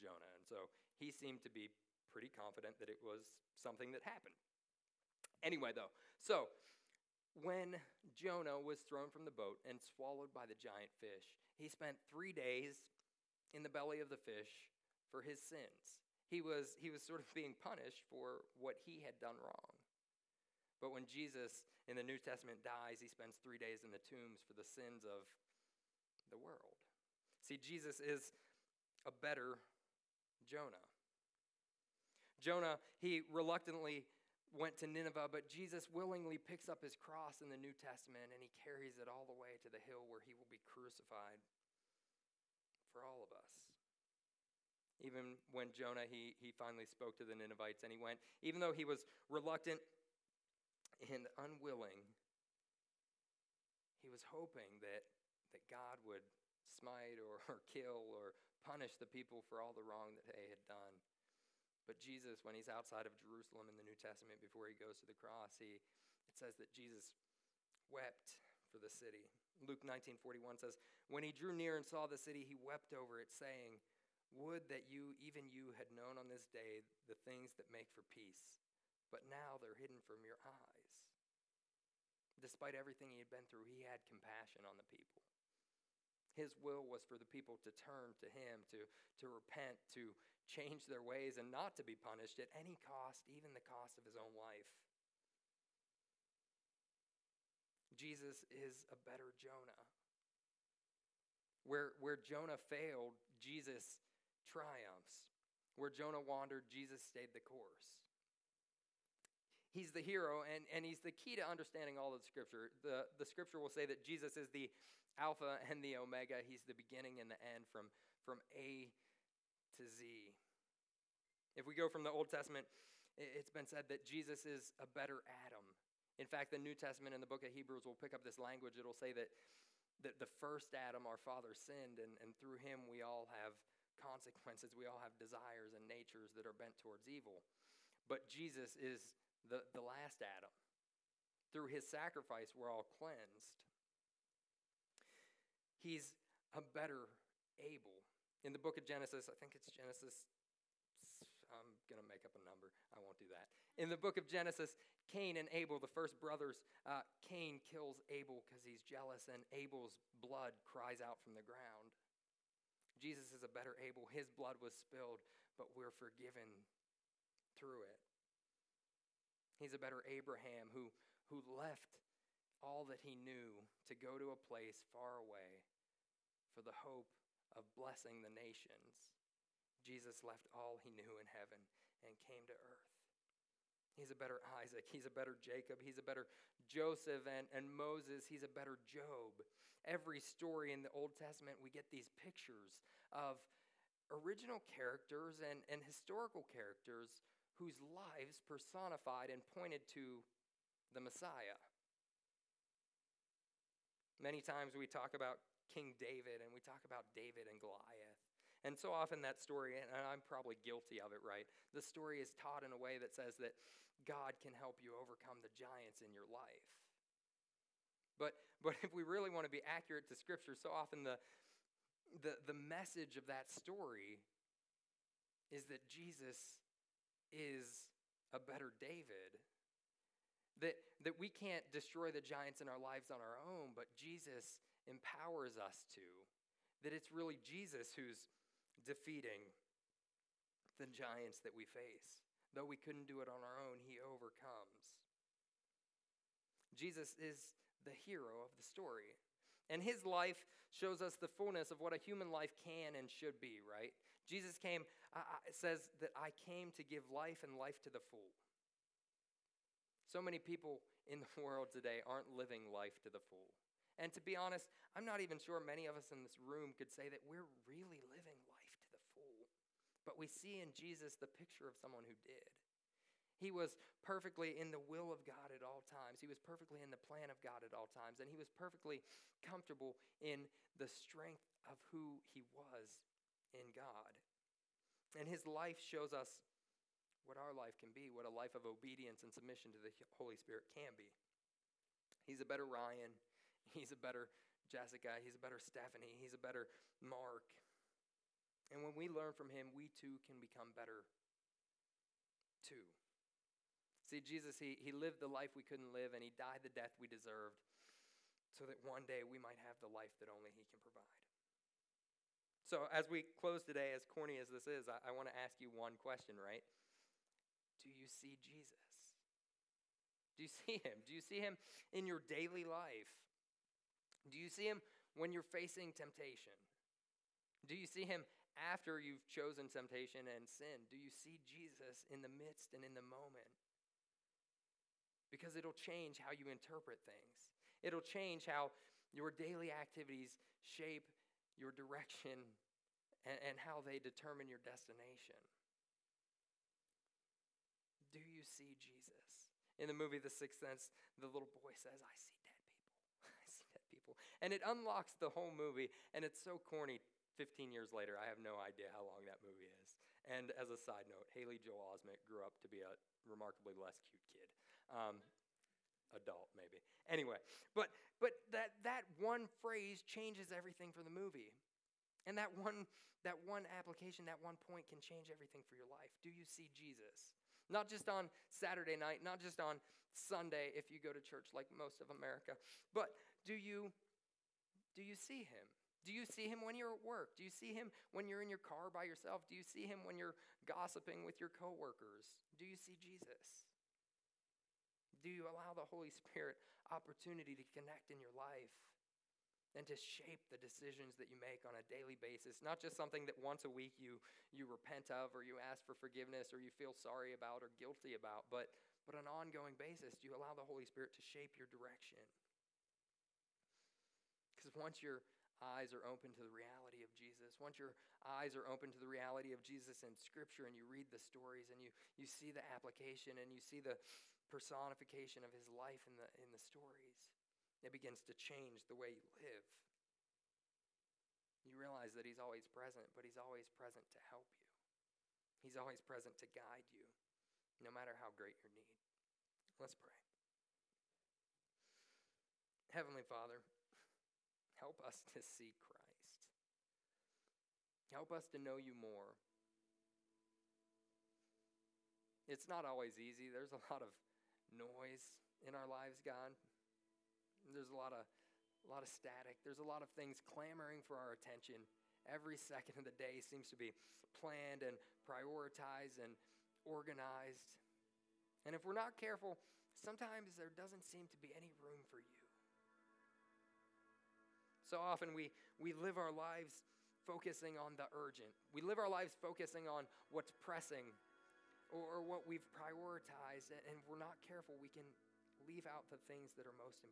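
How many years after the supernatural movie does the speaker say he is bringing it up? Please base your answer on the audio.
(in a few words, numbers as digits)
15.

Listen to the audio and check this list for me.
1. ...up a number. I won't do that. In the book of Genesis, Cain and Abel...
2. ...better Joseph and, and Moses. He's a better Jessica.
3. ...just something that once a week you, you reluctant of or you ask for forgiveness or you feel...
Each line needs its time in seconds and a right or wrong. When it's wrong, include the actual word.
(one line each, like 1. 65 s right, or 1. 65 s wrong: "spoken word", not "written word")
1. 152 s right
2. 186 s wrong: "Job", not "Jessica"
3. 402 s wrong: "repent", not "reluctant".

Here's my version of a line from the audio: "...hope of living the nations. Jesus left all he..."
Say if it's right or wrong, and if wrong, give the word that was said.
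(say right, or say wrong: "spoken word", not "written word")
wrong: "blessing", not "living".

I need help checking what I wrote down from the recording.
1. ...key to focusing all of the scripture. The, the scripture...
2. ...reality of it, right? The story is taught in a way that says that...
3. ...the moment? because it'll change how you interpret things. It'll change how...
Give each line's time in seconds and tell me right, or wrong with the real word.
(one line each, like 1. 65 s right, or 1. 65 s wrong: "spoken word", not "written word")
1. 111 s wrong: "understanding", not "focusing"
2. 210 s wrong: "guilty", not "reality"
3. 332 s right.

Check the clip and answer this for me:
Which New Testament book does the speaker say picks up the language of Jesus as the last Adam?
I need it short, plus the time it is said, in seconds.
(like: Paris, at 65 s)
Hebrews, at 127 s.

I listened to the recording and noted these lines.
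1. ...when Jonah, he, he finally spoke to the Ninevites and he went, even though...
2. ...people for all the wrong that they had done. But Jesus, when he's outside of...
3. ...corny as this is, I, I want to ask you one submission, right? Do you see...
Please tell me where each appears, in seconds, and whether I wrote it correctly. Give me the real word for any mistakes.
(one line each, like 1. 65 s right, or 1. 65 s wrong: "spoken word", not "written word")
1. 45 s right
2. 59 s right
3. 314 s wrong: "question", not "submission".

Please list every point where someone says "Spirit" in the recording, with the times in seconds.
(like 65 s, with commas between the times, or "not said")
290 s, 396 s, 410 s.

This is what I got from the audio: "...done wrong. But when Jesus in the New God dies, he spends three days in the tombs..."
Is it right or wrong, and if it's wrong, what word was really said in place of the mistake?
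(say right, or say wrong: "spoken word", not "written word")
wrong: "Testament", not "God".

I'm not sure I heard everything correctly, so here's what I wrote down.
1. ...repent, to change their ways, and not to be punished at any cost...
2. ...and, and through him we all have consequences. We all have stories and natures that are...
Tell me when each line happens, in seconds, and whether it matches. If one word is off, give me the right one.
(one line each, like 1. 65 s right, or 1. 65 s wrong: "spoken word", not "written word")
1. 89 s right
2. 131 s wrong: "desires", not "stories".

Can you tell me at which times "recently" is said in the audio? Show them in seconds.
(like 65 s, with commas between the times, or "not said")
not said.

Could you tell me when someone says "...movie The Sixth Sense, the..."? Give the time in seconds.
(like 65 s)
349 s.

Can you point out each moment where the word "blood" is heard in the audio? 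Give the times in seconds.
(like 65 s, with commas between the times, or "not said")
160 s, 164 s.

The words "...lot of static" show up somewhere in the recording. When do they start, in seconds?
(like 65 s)
458 s.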